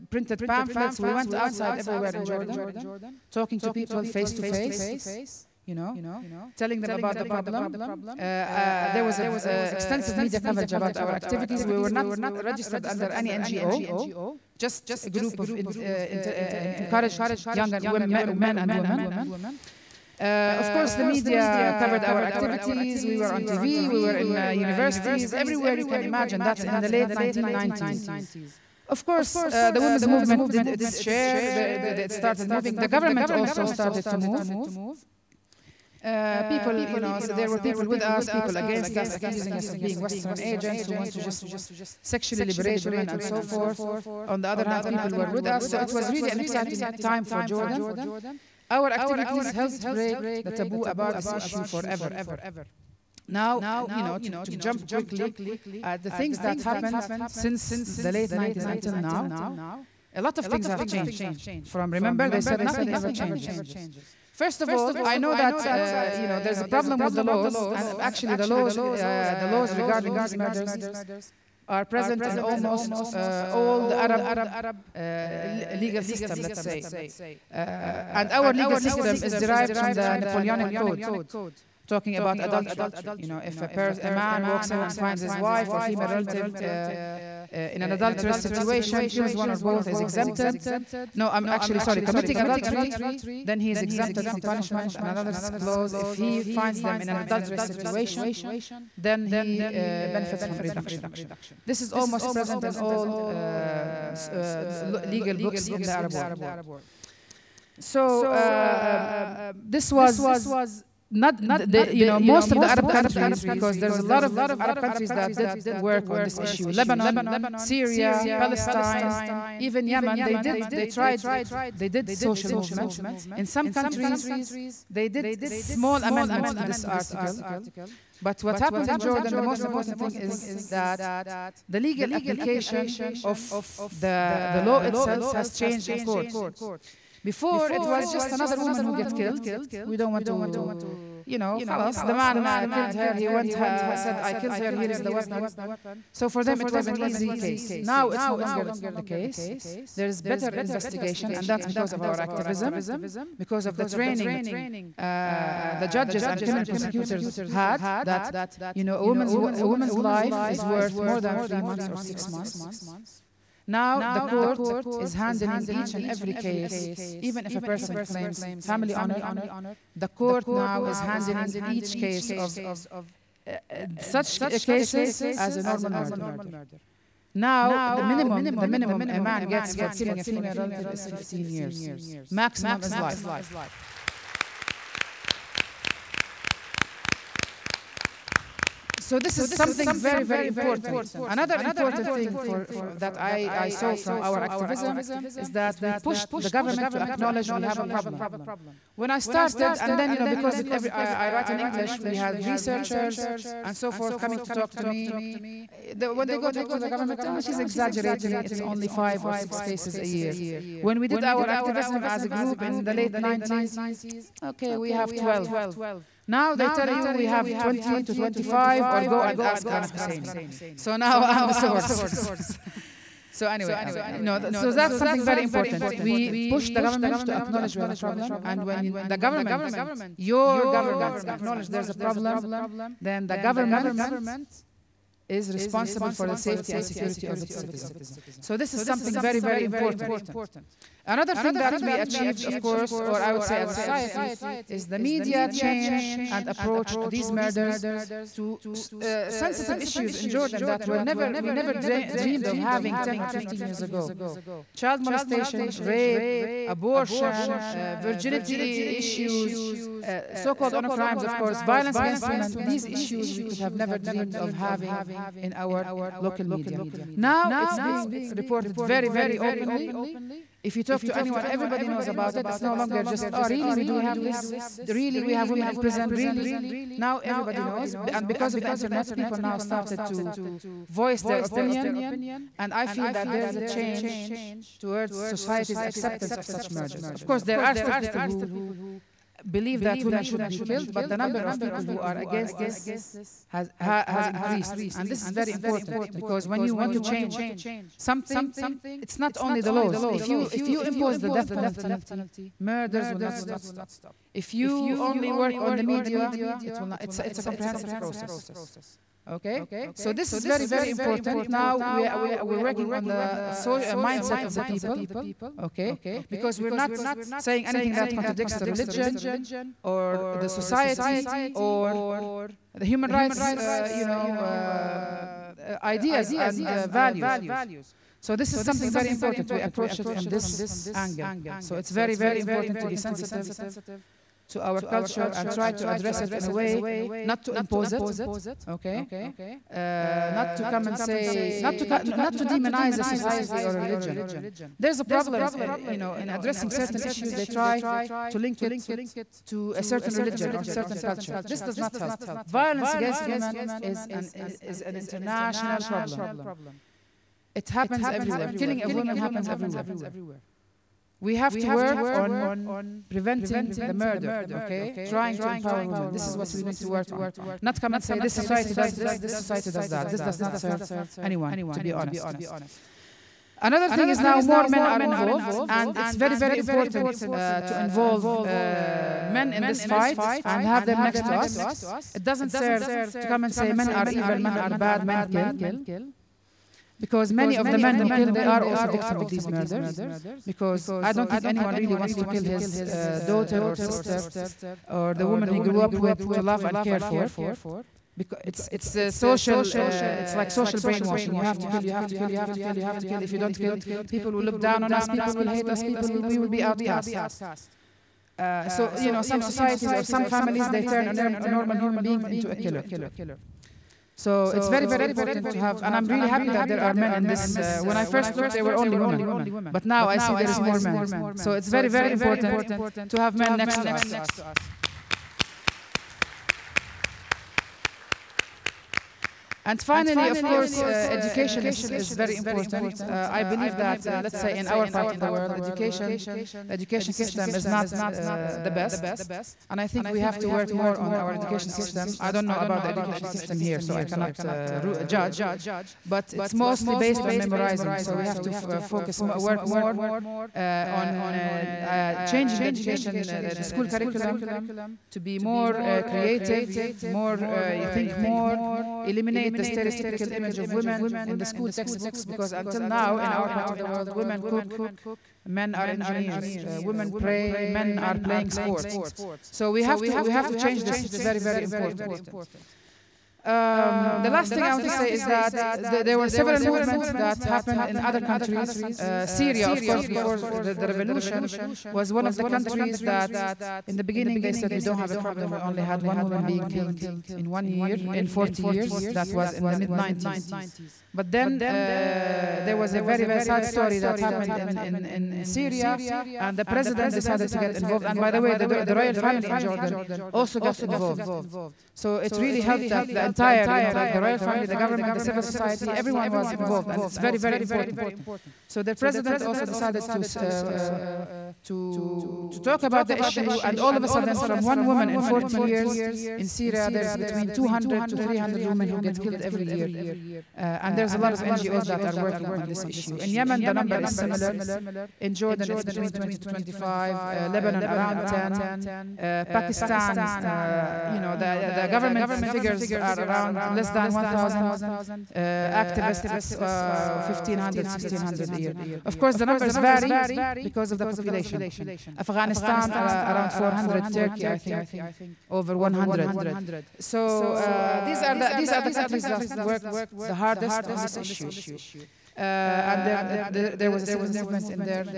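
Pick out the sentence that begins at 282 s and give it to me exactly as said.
And I feel that there's a change towards society's acceptance of such murders.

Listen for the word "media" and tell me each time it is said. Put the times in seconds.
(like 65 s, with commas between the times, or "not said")
10 s, 21 s, 244 s, 266 s, 305 s.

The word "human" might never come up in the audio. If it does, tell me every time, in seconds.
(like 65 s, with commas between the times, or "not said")
322 s, 411 s.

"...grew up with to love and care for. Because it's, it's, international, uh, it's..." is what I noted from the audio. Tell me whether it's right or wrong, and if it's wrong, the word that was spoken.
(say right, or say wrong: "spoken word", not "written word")
wrong: "social", not "international".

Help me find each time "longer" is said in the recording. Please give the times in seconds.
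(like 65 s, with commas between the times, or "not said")
148 s, 272 s.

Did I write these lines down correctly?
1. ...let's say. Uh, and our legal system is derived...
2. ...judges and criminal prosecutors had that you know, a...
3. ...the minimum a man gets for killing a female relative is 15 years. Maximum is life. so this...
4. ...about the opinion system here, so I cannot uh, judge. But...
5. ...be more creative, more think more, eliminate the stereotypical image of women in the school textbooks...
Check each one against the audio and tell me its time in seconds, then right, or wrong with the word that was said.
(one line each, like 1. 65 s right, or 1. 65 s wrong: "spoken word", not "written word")
1. 76 s right
2. 155 s right
3. 178 s right
4. 442 s wrong: "education", not "opinion"
5. 455 s right.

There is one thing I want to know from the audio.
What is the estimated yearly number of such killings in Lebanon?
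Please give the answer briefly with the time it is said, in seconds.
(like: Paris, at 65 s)
around 10, at 527 s.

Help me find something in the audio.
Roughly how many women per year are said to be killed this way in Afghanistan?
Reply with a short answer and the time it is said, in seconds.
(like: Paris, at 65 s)
around 400, at 542 s.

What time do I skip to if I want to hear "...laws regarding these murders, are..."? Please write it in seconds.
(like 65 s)
69 s.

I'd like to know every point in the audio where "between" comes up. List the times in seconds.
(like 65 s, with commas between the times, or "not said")
517 s, 525 s.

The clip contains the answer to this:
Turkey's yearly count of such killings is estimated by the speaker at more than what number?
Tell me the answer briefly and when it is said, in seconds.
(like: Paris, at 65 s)
over 100, at 545 s.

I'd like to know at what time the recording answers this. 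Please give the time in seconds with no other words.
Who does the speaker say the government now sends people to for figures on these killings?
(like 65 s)
219 s.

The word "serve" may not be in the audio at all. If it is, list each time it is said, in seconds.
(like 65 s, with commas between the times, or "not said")
370 s, 382 s.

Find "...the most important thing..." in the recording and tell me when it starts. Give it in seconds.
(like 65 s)
129 s.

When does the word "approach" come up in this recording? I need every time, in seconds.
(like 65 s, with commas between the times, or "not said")
246 s, 329 s.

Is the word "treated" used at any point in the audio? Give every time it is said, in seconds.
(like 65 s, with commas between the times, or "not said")
not said.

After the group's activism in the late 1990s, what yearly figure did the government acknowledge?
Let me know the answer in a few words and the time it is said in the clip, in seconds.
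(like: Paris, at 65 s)
12, at 215 s.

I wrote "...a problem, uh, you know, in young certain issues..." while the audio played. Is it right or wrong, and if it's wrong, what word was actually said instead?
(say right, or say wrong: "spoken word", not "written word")
wrong: "addressing", not "young".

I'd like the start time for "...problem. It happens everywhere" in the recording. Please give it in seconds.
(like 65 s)
355 s.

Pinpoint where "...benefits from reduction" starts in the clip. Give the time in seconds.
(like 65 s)
100 s.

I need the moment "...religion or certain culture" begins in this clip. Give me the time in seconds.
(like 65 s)
350 s.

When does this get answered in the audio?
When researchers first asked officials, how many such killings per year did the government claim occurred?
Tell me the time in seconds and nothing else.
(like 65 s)
208 s.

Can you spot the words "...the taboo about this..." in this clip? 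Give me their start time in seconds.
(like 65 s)
50 s.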